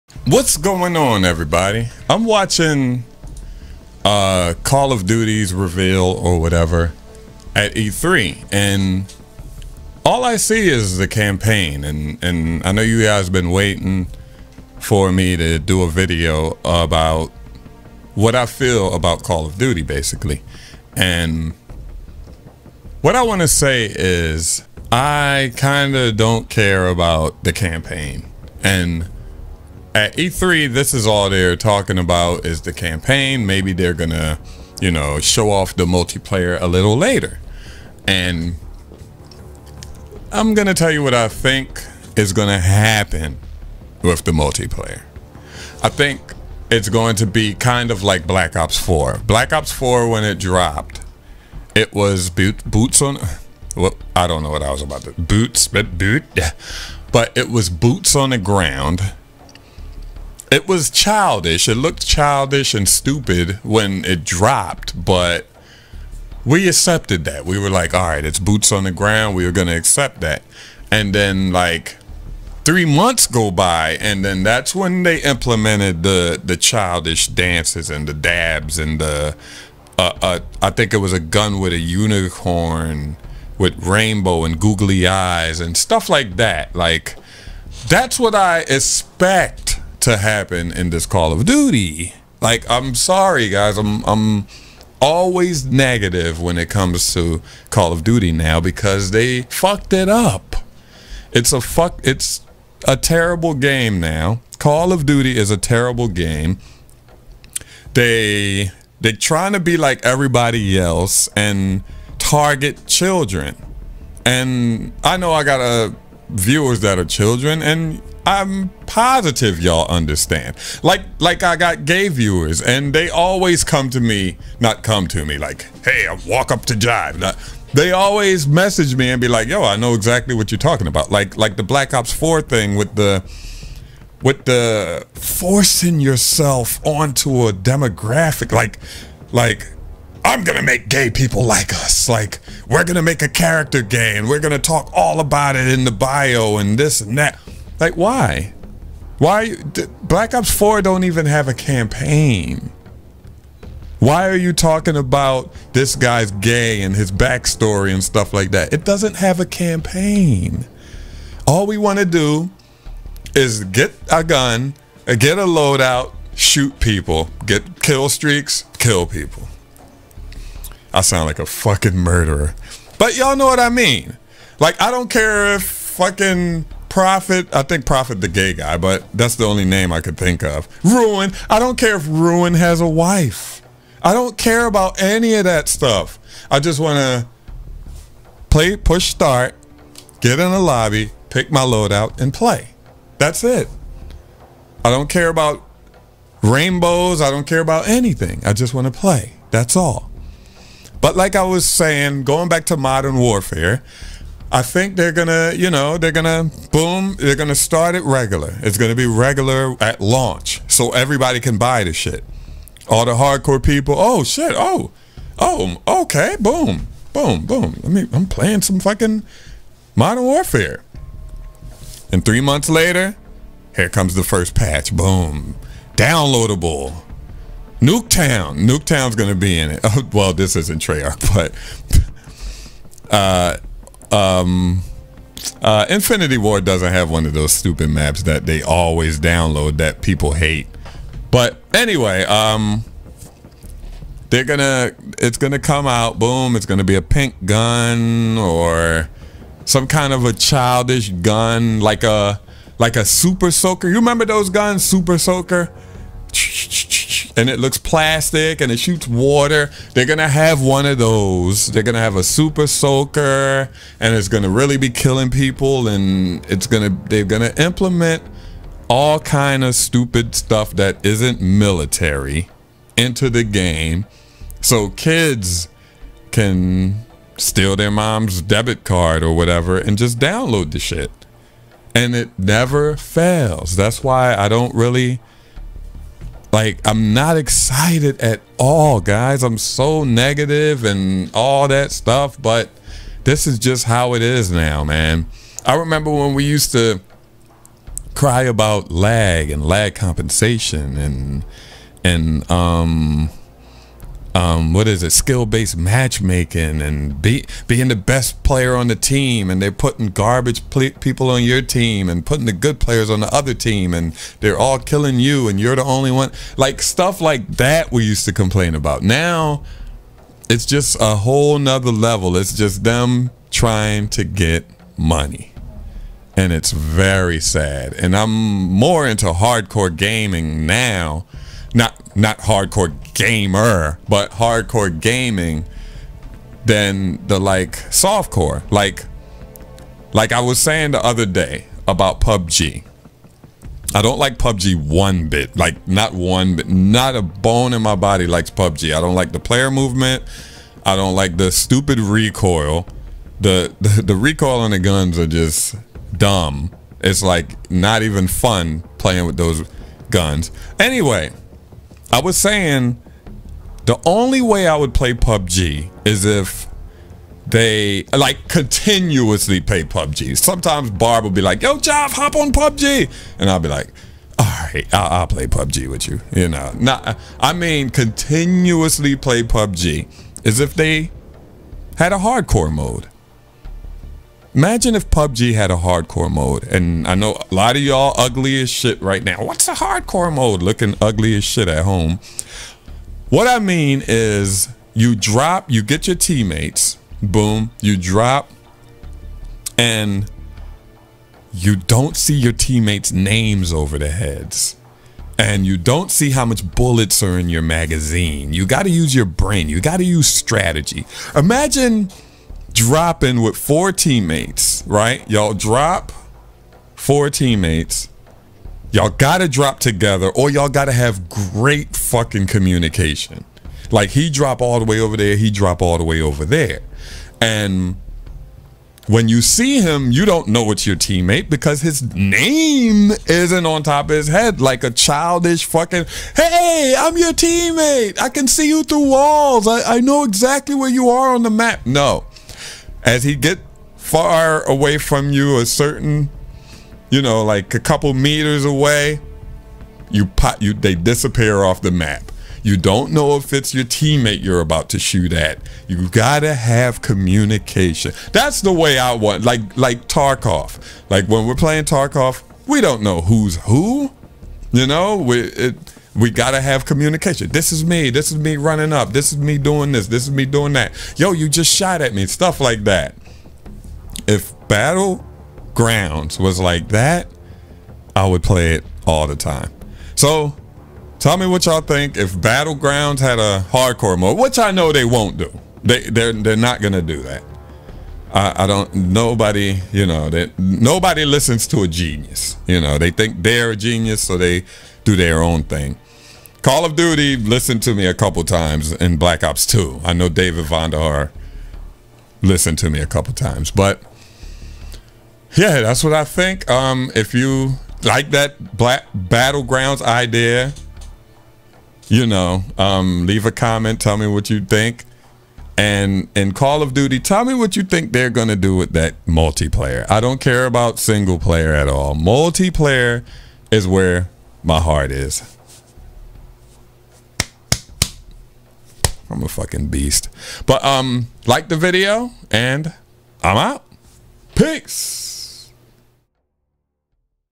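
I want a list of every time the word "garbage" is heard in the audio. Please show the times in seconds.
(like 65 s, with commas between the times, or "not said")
310 s.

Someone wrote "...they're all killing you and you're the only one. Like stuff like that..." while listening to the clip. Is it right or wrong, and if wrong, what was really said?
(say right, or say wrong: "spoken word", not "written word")
right.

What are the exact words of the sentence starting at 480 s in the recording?
So tell me what y'all think if Battlegrounds had a hardcore mode, which I know they won't do.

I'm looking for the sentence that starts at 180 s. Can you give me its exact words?
Ruin, I don't care if Ruin has a wife.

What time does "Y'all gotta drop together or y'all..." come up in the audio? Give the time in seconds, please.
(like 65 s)
418 s.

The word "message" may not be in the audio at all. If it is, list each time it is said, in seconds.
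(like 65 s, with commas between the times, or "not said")
128 s.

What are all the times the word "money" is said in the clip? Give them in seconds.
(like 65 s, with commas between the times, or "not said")
324 s.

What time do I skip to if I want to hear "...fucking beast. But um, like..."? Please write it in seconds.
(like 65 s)
529 s.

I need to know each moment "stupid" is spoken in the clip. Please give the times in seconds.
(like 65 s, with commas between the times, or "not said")
62 s, 237 s, 269 s, 351 s.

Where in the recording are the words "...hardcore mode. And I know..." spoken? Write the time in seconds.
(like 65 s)
385 s.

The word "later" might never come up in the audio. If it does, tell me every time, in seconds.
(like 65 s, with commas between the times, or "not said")
36 s, 222 s.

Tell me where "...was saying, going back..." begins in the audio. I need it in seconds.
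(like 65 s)
201 s.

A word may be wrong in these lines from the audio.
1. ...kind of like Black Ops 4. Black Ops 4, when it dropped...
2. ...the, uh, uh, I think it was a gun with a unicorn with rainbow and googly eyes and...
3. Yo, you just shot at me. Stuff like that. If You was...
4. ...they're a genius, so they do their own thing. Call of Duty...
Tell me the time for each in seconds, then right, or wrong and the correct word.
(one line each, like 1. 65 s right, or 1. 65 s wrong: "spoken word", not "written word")
1. 47 s right
2. 78 s right
3. 471 s wrong: "Battlegrounds", not "You"
4. 493 s right.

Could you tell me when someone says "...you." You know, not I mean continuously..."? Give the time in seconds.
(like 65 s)
376 s.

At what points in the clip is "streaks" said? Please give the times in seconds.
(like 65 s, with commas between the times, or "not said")
168 s.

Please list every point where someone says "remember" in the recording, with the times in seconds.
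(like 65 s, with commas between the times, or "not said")
253 s, 295 s.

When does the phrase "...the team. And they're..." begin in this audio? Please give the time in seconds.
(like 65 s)
308 s.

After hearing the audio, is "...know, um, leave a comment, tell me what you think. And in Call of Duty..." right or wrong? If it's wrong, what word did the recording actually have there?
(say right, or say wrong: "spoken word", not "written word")
right.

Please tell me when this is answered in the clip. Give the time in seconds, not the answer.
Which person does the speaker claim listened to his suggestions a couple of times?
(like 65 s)
500 s.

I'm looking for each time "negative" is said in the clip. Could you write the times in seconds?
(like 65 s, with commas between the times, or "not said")
95 s, 290 s.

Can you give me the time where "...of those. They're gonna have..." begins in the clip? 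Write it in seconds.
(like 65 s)
260 s.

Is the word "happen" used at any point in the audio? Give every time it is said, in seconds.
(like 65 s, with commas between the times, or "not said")
42 s, 90 s.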